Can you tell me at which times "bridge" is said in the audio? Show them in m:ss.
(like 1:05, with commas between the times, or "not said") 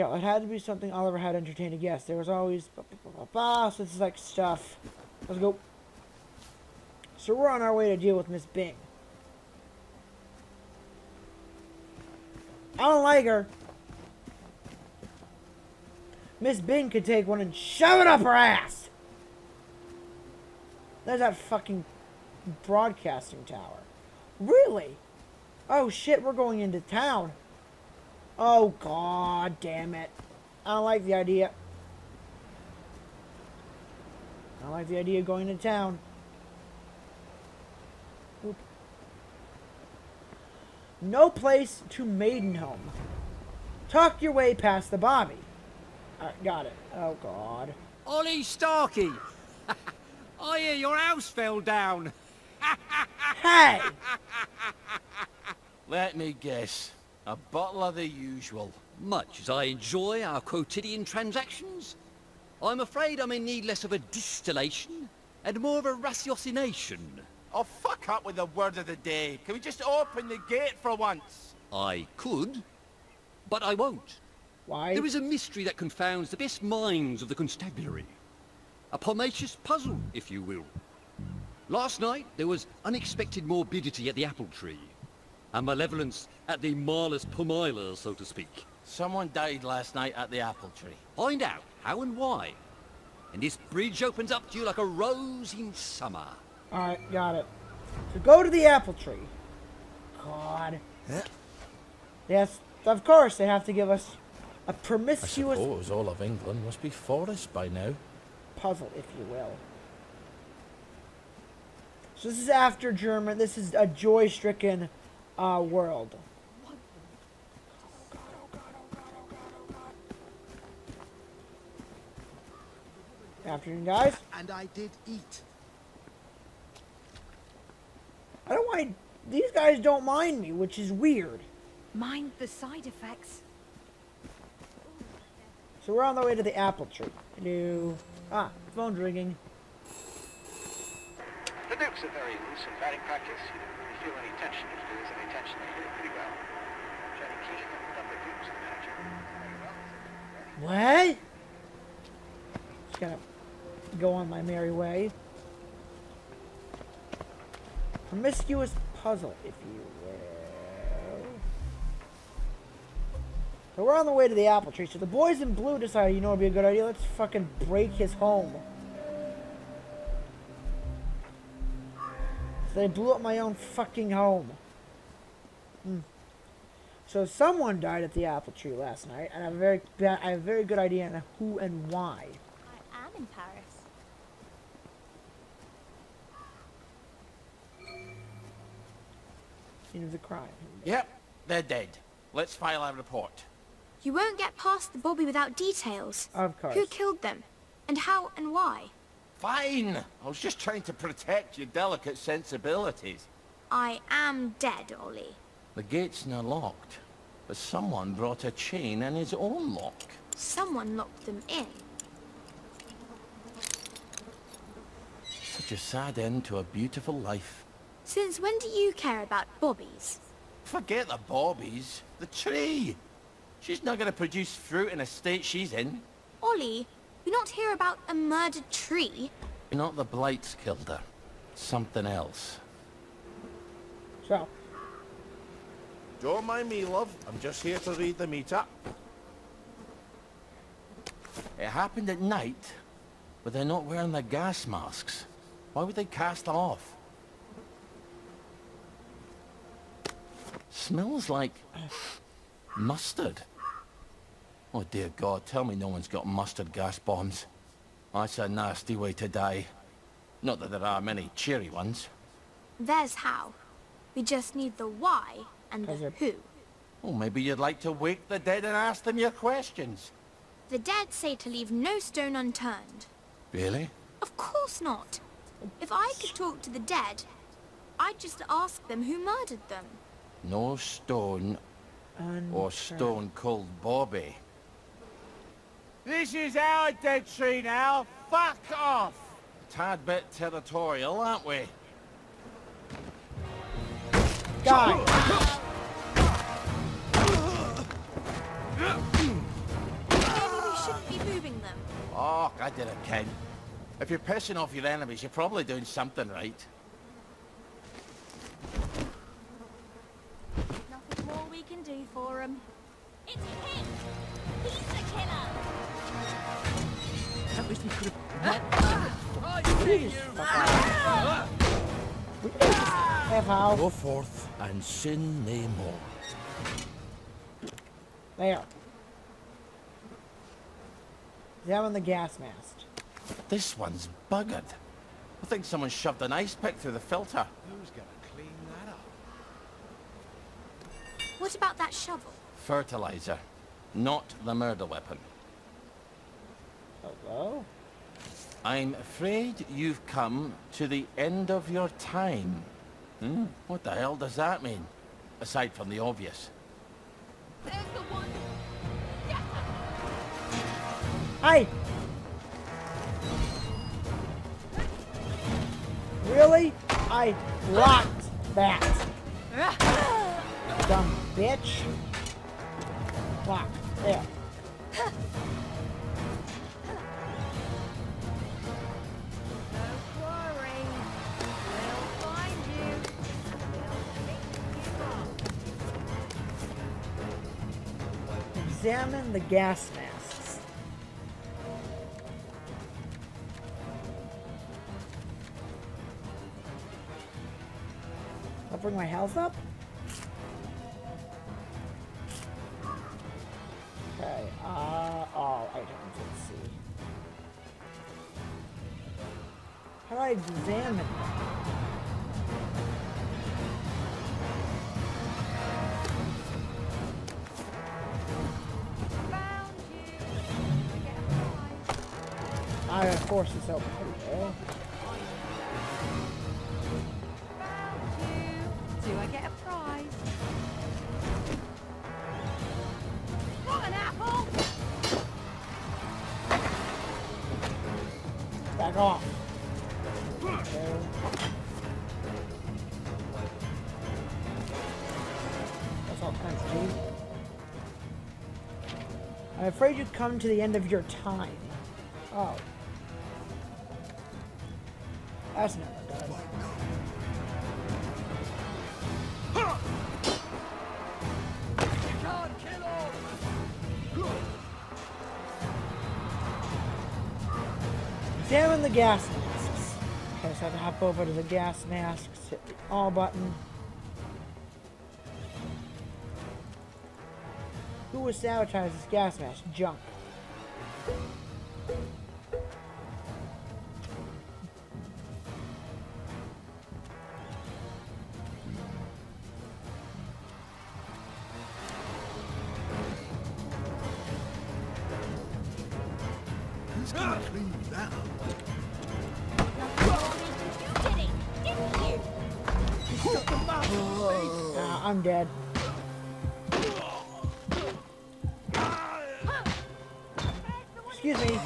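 1:33.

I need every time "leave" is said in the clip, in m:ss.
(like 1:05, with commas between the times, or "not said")
4:31.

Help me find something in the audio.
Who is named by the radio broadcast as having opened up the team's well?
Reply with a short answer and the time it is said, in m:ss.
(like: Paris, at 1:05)
Jenny Keane, at 2:27.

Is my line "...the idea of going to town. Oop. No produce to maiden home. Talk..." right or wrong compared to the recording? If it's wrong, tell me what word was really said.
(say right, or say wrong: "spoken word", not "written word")
wrong: "place", not "produce".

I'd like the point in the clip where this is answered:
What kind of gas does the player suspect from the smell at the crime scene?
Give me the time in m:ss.
4:16.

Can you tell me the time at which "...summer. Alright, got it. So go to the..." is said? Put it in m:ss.
1:35.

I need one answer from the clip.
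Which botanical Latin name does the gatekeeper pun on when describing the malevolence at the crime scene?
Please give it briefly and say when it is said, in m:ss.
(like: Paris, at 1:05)
Malus pumila, at 1:26.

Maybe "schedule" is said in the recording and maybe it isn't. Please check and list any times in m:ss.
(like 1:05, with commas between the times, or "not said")
not said.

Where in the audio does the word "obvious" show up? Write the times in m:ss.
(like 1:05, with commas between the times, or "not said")
5:56.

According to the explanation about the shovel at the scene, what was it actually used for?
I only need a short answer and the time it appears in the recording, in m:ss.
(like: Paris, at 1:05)
Fertilizer, at 5:42.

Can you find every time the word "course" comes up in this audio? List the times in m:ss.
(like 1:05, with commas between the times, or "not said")
1:43, 3:16, 4:34.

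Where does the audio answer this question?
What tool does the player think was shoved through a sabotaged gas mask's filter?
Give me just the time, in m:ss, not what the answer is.
5:36.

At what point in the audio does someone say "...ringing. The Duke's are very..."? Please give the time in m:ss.
2:18.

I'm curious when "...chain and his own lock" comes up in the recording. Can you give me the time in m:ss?
3:28.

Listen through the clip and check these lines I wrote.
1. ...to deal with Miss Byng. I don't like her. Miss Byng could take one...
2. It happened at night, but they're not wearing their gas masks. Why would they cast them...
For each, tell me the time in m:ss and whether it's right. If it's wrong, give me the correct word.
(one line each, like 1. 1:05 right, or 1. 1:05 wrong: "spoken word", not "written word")
1. 0:07 right
2. 4:01 right.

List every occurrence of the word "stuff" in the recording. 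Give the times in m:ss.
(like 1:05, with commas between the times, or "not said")
0:04.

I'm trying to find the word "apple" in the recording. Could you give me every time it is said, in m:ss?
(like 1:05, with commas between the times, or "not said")
1:24, 1:30, 1:38, 2:16, 2:44, 2:58.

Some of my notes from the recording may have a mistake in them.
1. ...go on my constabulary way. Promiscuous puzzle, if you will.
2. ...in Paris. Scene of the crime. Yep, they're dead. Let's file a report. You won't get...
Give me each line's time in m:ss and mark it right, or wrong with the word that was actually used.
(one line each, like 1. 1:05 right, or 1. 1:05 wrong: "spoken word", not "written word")
1. 2:33 wrong: "merry", not "constabulary"
2. 3:03 right.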